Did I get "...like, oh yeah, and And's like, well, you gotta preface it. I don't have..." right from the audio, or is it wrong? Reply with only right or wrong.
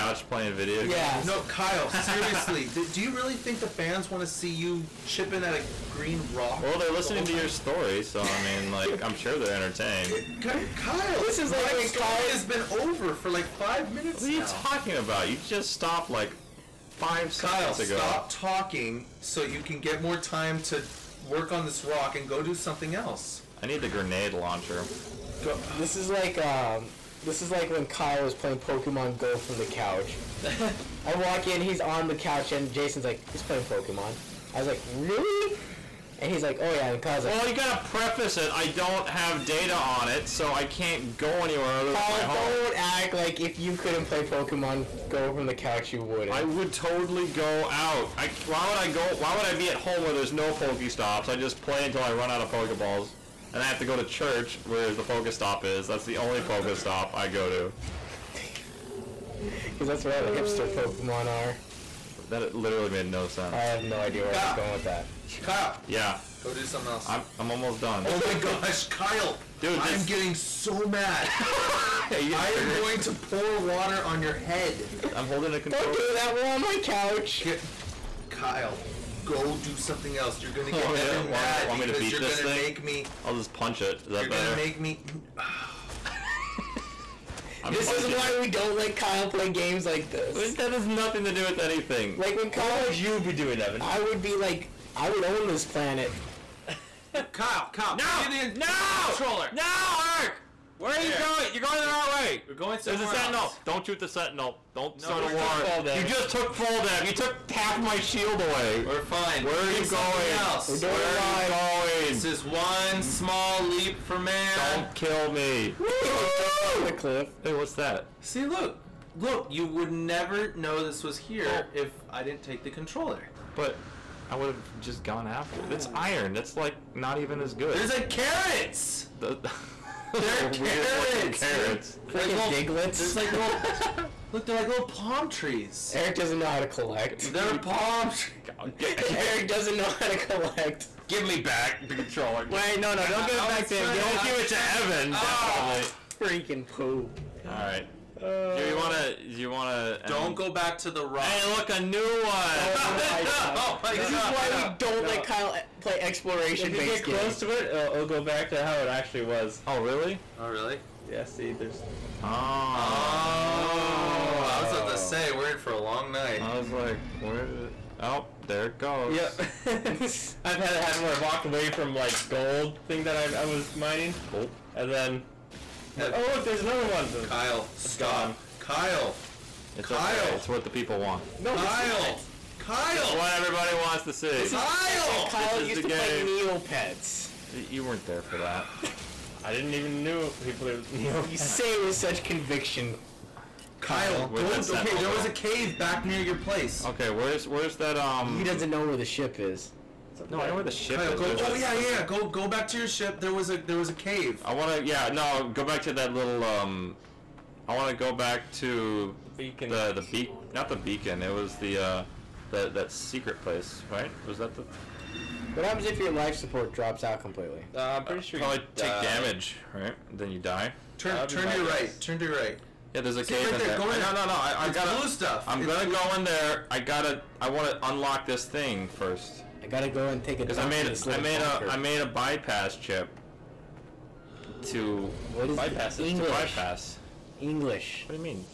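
wrong.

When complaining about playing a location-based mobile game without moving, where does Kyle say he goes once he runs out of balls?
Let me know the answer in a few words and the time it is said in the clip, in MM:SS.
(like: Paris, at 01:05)
church, at 00:54.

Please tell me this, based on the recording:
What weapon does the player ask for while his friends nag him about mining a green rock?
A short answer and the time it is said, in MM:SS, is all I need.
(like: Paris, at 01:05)
grenade launcher, at 00:23.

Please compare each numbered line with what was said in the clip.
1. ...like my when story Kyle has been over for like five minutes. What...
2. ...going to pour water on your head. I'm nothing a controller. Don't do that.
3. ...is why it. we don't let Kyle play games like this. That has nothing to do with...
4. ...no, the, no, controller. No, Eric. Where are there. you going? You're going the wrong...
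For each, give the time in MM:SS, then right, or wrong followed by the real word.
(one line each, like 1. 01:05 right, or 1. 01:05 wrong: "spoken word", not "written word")
1. 00:11 right
2. 01:12 wrong: "holding", not "nothing"
3. 01:27 right
4. 01:37 right.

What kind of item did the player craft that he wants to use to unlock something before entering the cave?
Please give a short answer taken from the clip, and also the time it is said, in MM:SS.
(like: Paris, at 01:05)
bypass chip, at 03:52.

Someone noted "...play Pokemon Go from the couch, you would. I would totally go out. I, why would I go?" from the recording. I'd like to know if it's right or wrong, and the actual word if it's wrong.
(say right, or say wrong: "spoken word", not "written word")
right.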